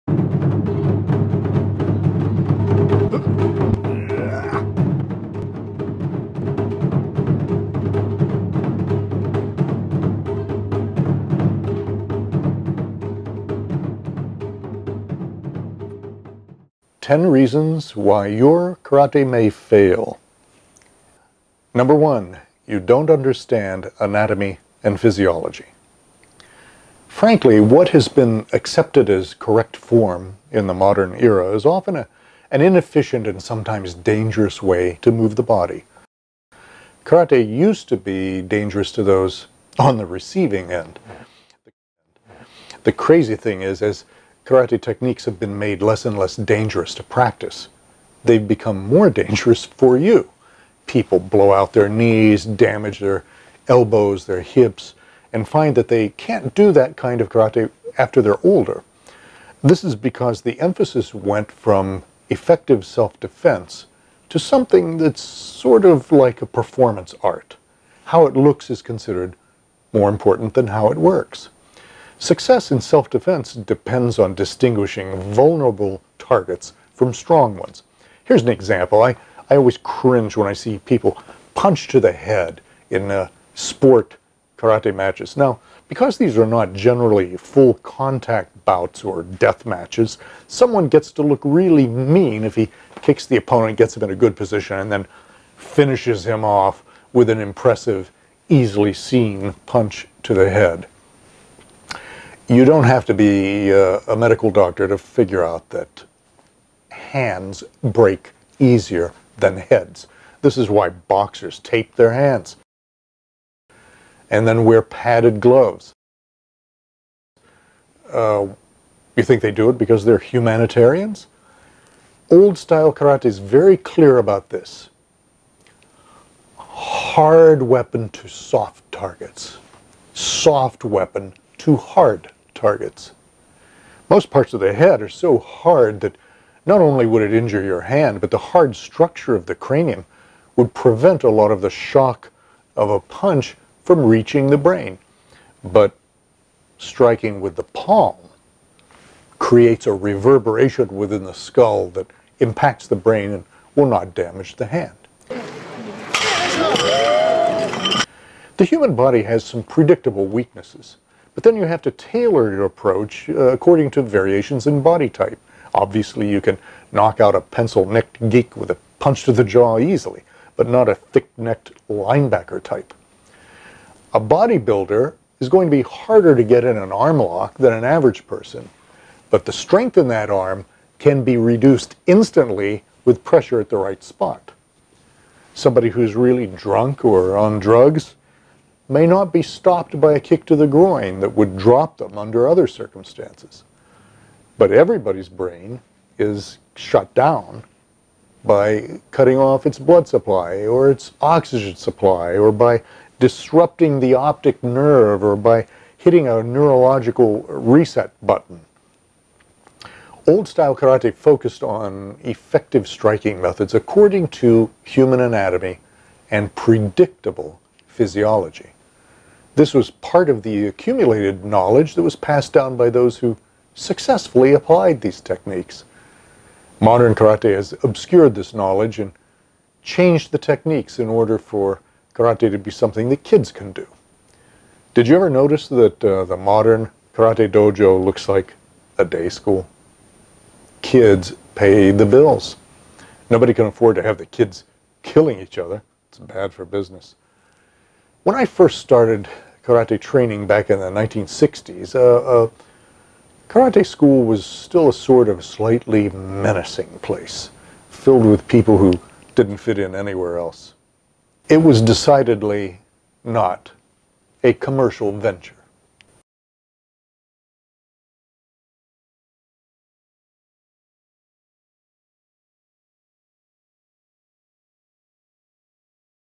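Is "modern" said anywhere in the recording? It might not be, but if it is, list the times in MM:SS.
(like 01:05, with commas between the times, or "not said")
00:30, 03:46, 03:56.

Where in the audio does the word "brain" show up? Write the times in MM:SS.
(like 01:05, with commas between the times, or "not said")
02:24, 02:32, 03:15.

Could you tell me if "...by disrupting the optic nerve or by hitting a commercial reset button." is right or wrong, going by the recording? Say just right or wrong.
wrong.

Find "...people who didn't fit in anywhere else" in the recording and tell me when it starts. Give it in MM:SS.
04:18.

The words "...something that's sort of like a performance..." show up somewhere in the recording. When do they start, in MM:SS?
01:04.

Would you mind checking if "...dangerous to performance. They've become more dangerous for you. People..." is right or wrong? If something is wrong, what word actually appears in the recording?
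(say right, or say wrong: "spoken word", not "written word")
wrong: "practice", not "performance".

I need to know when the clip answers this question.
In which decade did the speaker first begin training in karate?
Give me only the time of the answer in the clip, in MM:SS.
04:10.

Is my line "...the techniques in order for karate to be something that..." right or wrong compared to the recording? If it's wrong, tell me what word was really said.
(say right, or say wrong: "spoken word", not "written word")
right.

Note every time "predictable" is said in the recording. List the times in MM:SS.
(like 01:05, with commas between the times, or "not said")
02:39, 03:36.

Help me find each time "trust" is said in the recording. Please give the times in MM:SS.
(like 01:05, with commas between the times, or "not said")
not said.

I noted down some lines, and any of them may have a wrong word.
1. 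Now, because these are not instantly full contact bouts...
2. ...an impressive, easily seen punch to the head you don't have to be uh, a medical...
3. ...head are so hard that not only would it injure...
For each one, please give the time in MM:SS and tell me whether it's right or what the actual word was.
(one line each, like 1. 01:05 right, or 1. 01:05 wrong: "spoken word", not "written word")
1. 01:25 wrong: "generally", not "instantly"
2. 01:37 right
3. 02:14 right.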